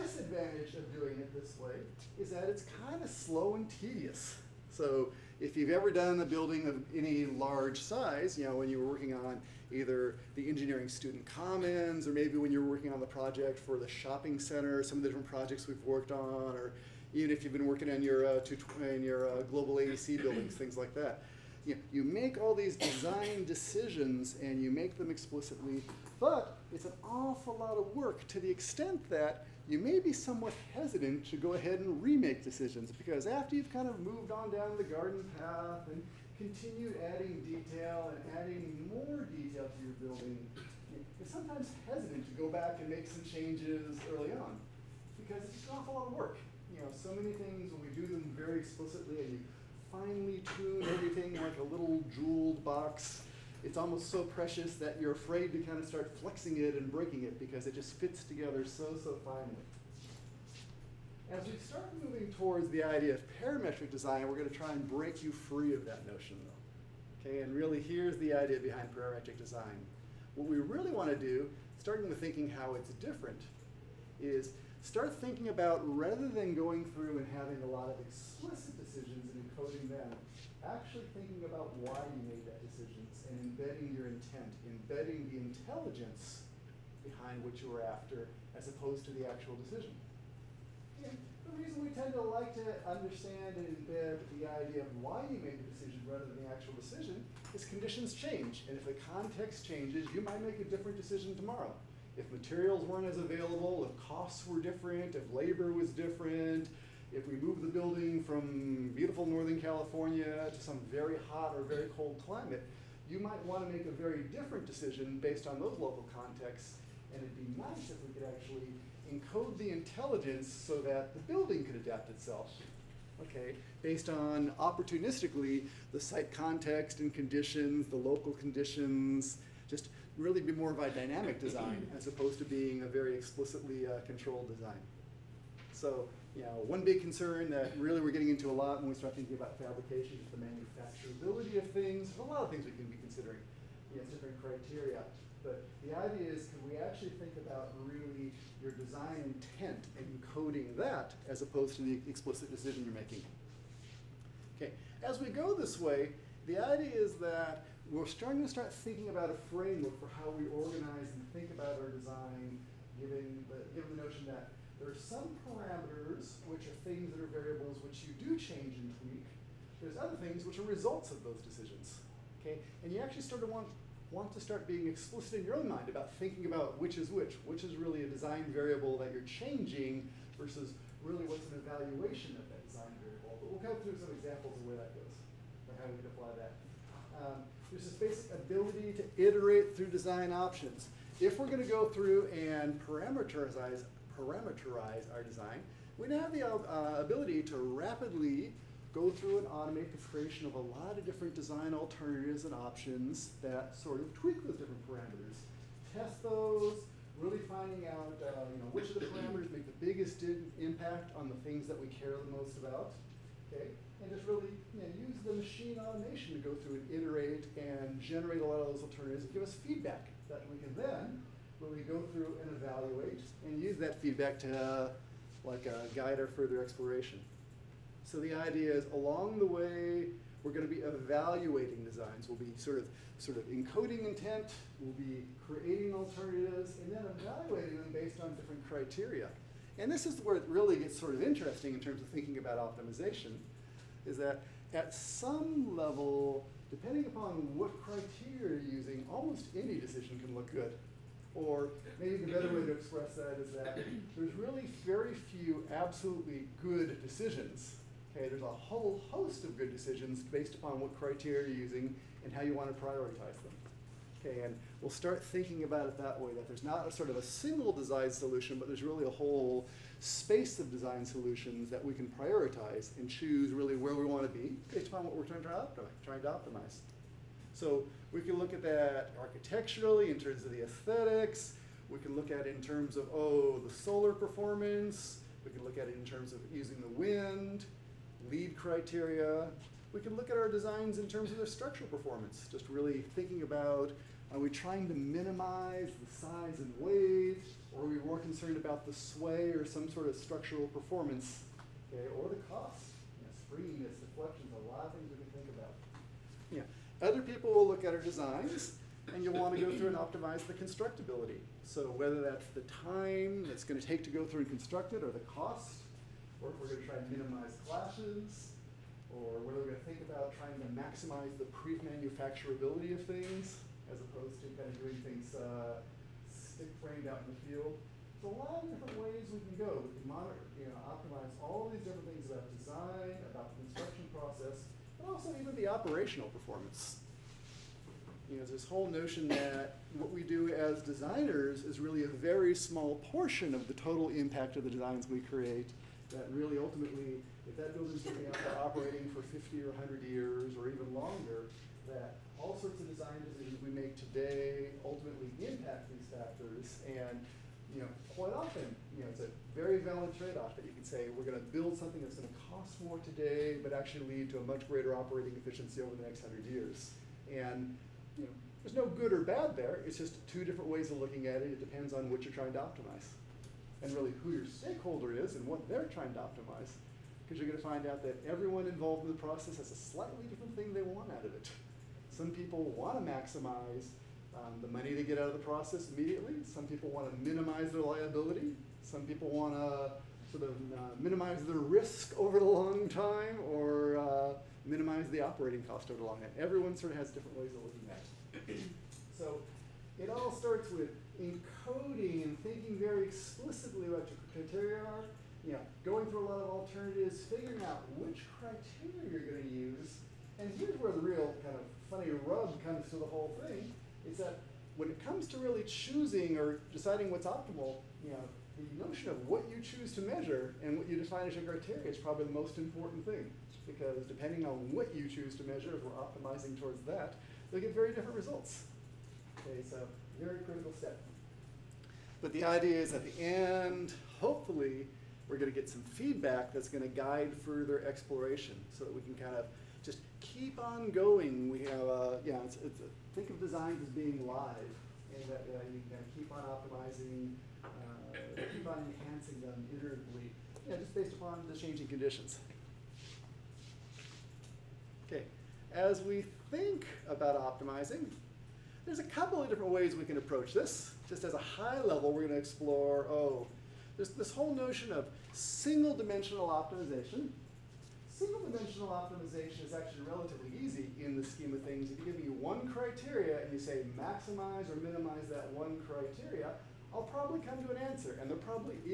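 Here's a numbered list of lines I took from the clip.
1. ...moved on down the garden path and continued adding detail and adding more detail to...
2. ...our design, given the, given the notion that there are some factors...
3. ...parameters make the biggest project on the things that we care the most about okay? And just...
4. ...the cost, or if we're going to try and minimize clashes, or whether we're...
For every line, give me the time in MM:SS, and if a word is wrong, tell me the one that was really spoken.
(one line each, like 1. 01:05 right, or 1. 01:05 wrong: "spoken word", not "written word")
1. 00:33 right
2. 02:41 wrong: "parameters", not "factors"
3. 03:29 wrong: "impact", not "project"
4. 05:15 right.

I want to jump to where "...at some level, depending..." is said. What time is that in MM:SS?
04:04.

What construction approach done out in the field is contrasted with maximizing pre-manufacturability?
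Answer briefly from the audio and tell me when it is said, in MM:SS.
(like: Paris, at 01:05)
stick framed, at 05:26.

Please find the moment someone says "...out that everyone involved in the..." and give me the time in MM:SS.
06:17.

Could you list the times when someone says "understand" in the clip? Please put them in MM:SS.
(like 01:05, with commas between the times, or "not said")
01:32.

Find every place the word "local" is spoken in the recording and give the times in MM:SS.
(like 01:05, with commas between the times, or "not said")
01:55, 02:07.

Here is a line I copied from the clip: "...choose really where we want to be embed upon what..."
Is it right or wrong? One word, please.
wrong.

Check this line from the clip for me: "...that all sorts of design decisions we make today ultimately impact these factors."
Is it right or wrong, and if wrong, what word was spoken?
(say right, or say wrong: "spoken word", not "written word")
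right.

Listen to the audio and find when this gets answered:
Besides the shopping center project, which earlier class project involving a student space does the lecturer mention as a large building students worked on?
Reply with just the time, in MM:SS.
00:10.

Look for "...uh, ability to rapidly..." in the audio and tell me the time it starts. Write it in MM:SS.
03:16.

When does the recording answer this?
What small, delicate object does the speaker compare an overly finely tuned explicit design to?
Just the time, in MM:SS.
00:51.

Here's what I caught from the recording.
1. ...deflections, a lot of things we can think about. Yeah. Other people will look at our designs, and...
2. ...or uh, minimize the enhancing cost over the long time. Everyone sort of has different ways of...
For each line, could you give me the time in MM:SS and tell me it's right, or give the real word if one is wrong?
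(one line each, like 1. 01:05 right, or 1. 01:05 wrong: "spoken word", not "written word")
1. 05:03 right
2. 06:33 wrong: "operating", not "enhancing".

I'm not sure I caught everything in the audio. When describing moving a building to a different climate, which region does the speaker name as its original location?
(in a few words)
Northern California.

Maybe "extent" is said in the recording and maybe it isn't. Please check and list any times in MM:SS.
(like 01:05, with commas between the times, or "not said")
00:28.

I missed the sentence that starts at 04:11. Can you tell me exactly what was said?
Or maybe the better way to express that is that there's really very few absolutely good decisions.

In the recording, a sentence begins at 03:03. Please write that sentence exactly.
But we'll go through some examples of where that goes, or how we can apply that.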